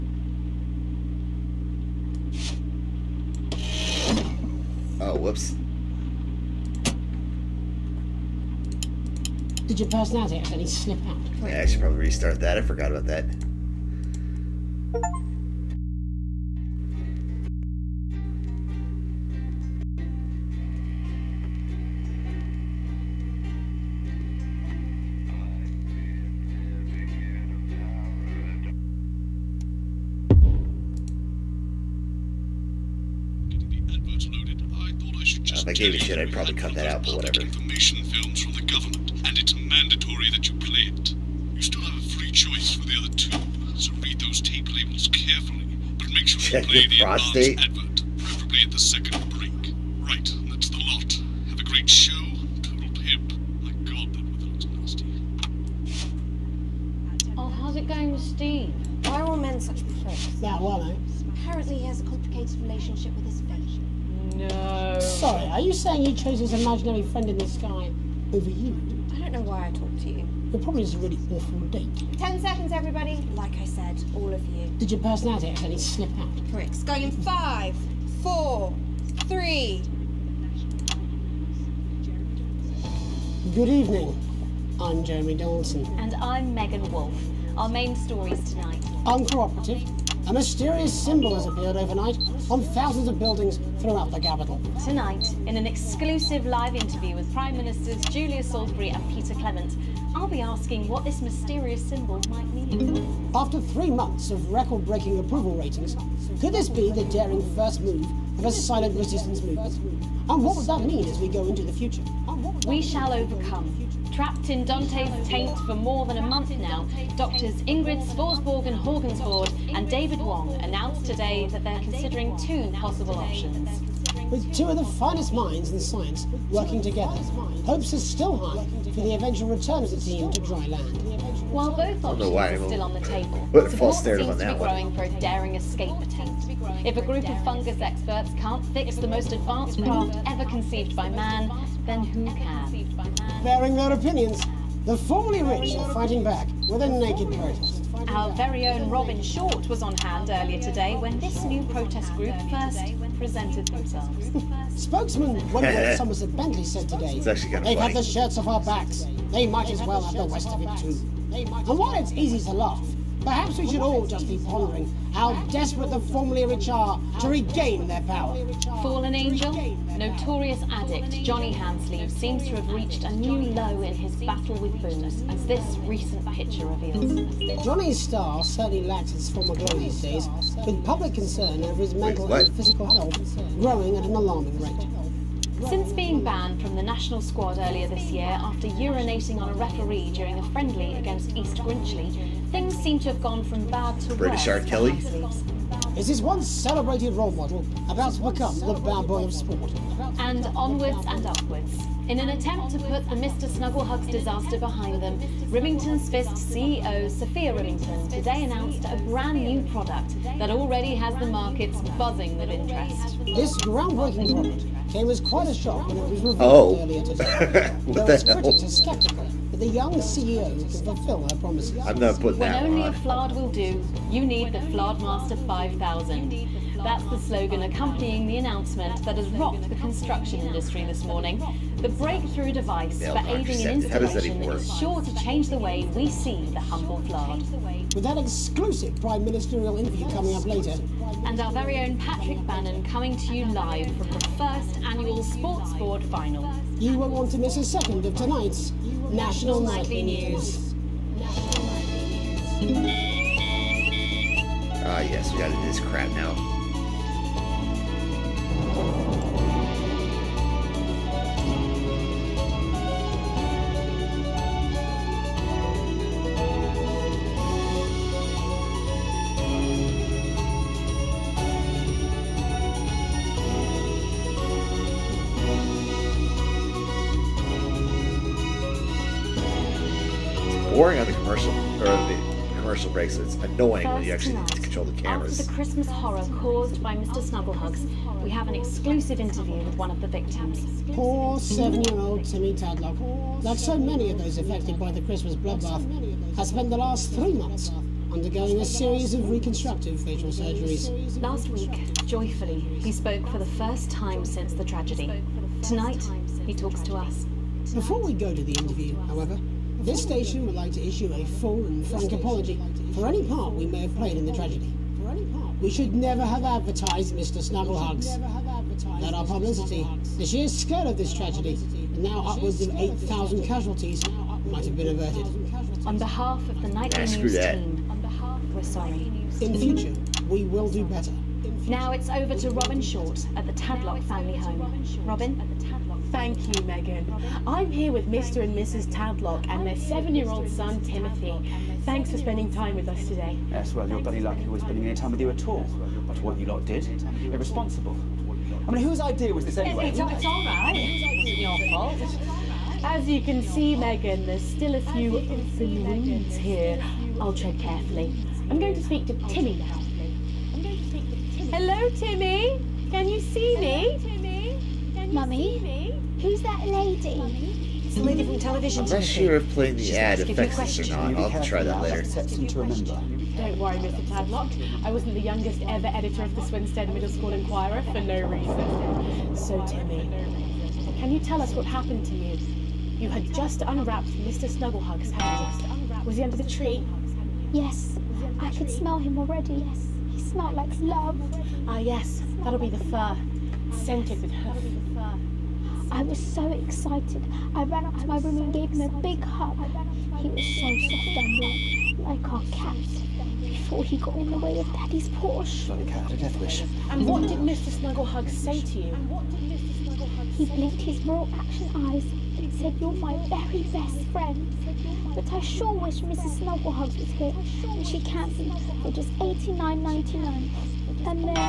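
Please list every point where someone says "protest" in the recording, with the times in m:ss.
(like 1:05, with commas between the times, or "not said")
2:27, 2:31.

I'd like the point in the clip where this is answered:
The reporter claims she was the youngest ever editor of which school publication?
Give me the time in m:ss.
6:16.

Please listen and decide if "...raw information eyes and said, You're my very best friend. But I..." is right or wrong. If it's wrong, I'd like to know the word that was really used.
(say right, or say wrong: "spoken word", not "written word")
wrong: "action", not "information".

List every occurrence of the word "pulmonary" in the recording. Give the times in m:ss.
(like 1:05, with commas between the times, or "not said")
not said.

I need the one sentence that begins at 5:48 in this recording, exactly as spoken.
I mean, whose idea was this anyway?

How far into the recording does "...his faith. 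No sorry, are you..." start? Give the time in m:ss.
1:03.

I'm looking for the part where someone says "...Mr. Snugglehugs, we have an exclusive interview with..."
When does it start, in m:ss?
4:46.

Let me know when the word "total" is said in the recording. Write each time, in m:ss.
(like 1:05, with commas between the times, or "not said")
0:52.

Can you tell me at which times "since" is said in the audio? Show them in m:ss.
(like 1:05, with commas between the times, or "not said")
3:05, 5:04.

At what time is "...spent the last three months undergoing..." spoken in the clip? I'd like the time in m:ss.
4:56.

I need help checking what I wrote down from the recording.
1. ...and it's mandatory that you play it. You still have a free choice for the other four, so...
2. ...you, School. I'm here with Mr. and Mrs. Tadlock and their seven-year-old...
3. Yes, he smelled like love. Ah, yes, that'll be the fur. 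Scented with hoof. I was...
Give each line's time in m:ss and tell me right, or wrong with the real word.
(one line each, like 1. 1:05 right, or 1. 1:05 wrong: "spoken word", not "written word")
1. 0:39 wrong: "two", not "four"
2. 5:36 wrong: "Megan", not "School"
3. 6:29 right.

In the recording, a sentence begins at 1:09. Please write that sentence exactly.
I don't know why I talked to you.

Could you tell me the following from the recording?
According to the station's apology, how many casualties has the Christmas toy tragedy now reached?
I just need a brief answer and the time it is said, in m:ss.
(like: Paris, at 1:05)
8,000, at 5:22.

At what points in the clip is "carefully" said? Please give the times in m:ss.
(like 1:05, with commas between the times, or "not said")
0:45, 5:57.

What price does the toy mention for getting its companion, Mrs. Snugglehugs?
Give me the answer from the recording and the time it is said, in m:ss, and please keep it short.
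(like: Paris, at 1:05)
89.99, at 6:59.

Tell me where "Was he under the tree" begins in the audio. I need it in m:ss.
6:26.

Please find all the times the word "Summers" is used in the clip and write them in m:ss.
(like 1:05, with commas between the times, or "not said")
2:35.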